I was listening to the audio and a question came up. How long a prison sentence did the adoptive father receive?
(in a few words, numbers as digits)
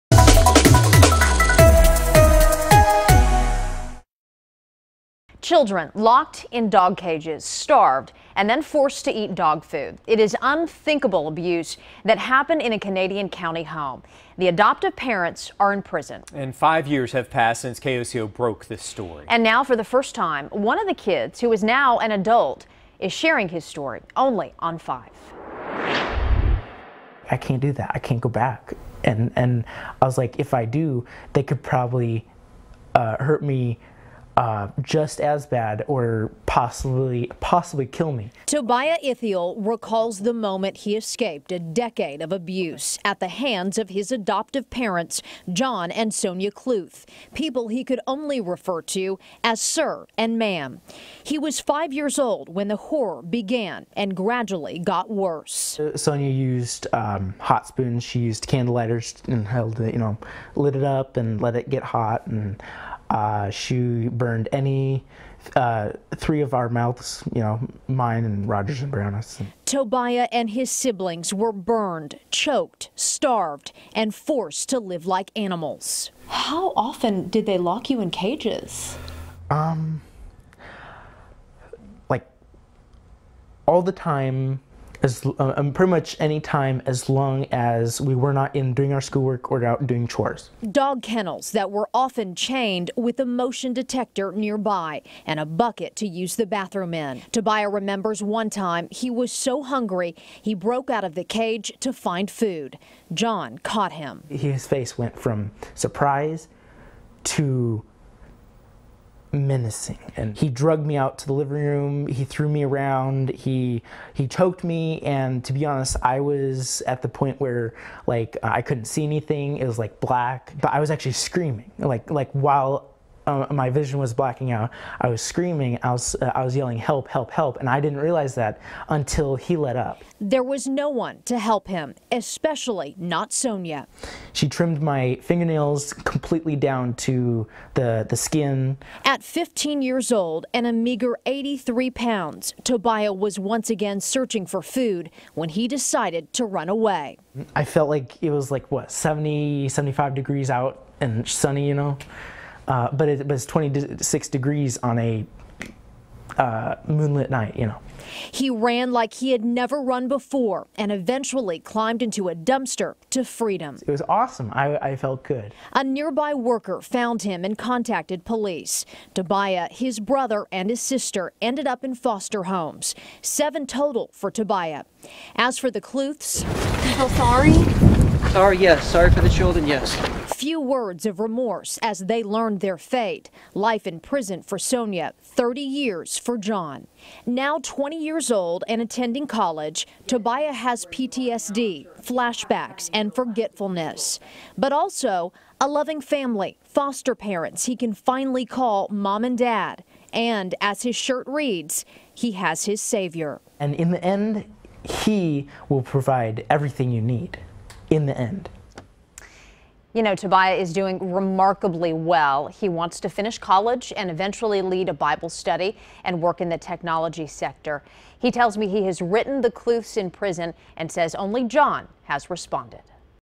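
30 years.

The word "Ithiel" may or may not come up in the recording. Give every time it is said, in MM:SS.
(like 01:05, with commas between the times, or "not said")
00:39.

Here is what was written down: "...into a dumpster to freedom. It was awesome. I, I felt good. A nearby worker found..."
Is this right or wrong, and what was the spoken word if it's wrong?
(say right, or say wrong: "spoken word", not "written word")
right.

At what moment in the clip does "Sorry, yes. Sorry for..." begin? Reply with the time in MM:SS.
02:58.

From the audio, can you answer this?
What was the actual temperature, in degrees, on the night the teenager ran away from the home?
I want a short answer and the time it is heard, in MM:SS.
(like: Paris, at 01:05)
26 degrees, at 02:33.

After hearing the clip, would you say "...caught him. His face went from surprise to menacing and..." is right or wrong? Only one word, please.
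right.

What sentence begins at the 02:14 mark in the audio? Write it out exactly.
She trimmed my fingernails completely down to the, the skin.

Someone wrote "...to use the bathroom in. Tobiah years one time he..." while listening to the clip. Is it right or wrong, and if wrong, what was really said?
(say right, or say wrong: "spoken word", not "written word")
wrong: "remembers", not "years".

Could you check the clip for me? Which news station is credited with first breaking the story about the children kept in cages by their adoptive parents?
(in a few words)
KOCO.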